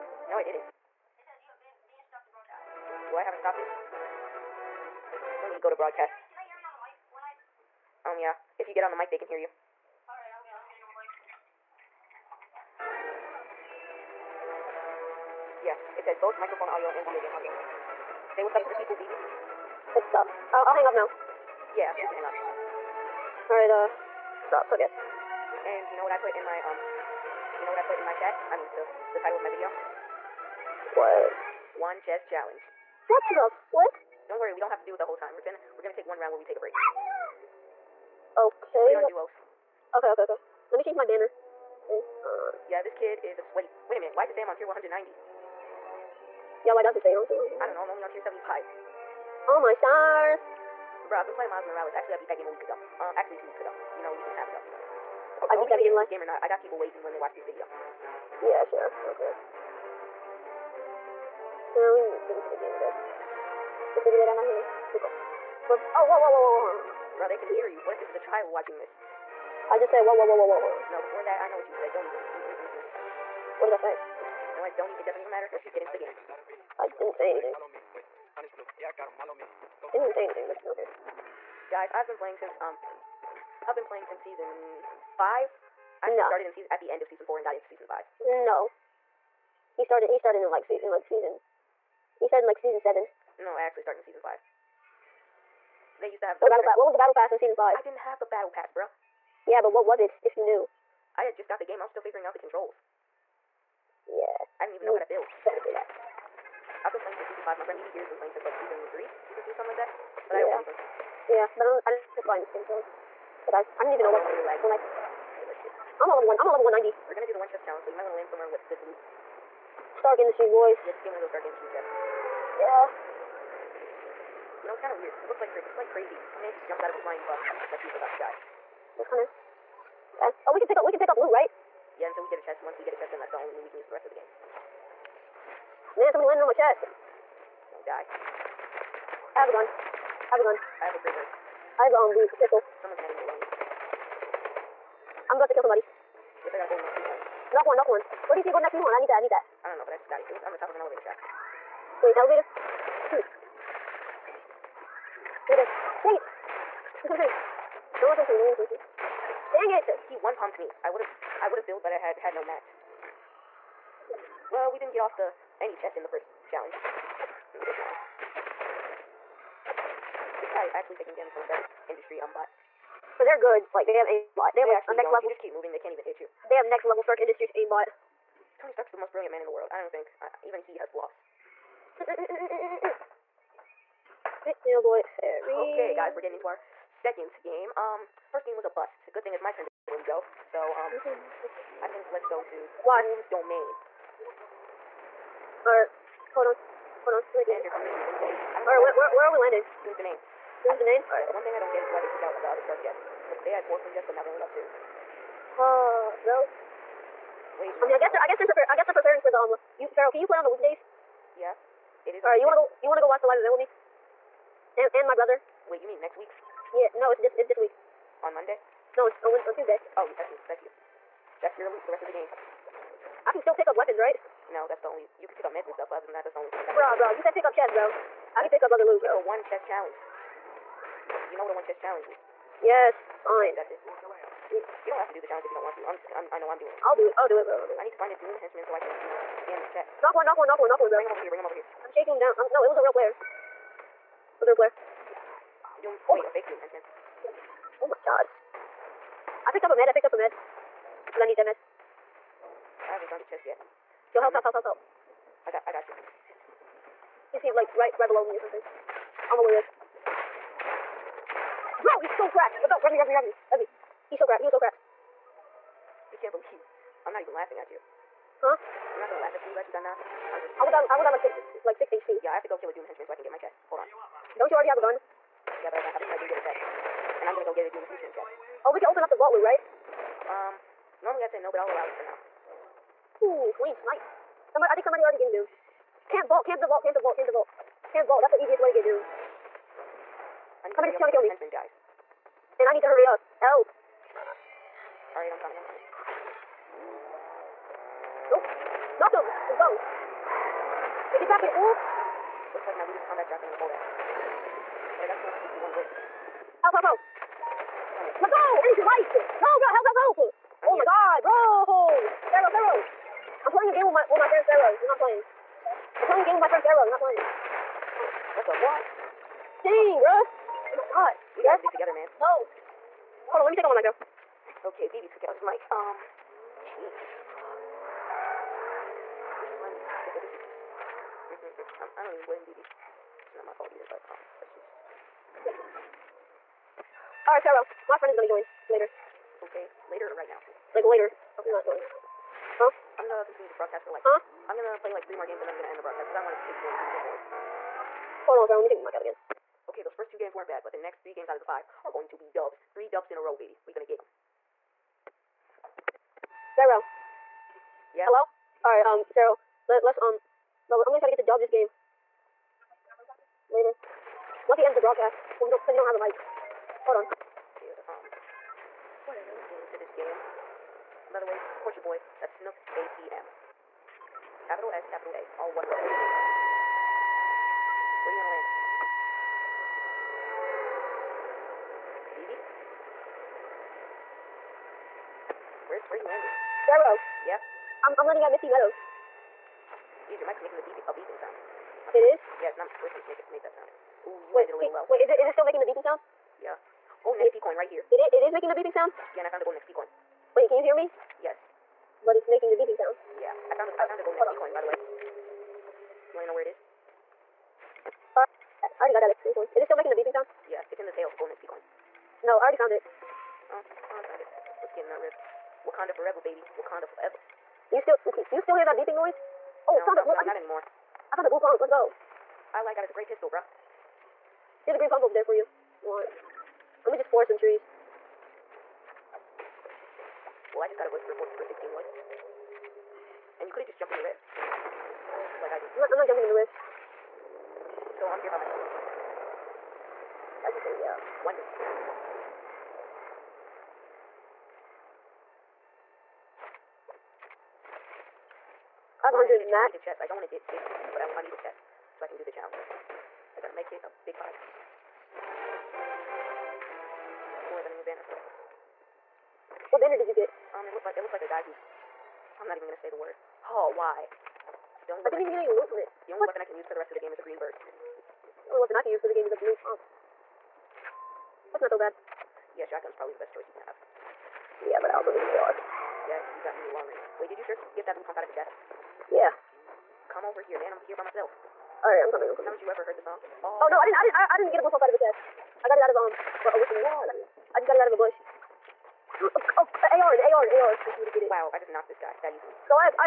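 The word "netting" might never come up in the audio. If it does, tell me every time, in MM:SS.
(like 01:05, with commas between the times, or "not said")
02:23.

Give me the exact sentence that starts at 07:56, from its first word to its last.
Yeah, you got me a long range.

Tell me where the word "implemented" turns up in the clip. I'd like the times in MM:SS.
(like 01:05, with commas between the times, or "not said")
not said.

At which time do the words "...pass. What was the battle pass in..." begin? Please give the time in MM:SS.
01:36.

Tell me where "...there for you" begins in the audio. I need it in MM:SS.
07:05.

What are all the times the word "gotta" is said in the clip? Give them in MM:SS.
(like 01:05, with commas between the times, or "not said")
05:21, 07:33.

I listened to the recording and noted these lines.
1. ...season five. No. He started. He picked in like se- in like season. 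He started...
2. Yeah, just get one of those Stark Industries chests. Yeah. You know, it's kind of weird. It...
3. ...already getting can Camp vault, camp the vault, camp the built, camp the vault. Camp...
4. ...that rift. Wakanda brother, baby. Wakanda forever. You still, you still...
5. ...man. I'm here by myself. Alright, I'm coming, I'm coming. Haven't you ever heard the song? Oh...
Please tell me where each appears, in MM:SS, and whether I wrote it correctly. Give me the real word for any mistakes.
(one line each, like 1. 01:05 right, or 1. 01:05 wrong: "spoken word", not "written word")
1. 01:27 wrong: "started", not "picked"
2. 02:00 right
3. 04:44 wrong: "vault", not "built"
4. 06:54 wrong: "forever", not "brother"
5. 08:00 right.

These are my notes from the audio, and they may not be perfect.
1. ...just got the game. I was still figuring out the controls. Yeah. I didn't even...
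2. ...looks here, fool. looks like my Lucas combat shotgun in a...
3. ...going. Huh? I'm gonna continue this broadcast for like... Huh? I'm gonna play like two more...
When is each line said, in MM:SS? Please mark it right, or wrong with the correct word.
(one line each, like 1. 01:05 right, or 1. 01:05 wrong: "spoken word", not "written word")
1. 01:41 right
2. 05:01 right
3. 05:41 wrong: "three", not "two".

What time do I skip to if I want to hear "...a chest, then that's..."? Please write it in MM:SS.
02:12.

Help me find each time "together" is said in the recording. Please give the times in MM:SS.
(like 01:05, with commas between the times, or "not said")
05:21, 05:30.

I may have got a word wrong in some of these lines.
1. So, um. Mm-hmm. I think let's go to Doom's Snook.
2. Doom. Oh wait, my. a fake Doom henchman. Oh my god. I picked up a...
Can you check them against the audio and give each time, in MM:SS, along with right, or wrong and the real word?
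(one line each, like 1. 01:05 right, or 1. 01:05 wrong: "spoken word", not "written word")
1. 03:10 wrong: "Domain", not "Snook"
2. 04:05 right.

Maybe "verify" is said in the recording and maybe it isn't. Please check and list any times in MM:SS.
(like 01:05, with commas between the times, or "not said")
not said.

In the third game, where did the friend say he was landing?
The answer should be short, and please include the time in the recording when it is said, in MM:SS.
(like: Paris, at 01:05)
Misty Meadows, at 06:28.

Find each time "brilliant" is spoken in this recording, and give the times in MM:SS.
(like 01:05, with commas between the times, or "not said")
02:59.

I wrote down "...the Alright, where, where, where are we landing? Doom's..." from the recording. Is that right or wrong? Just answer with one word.
right.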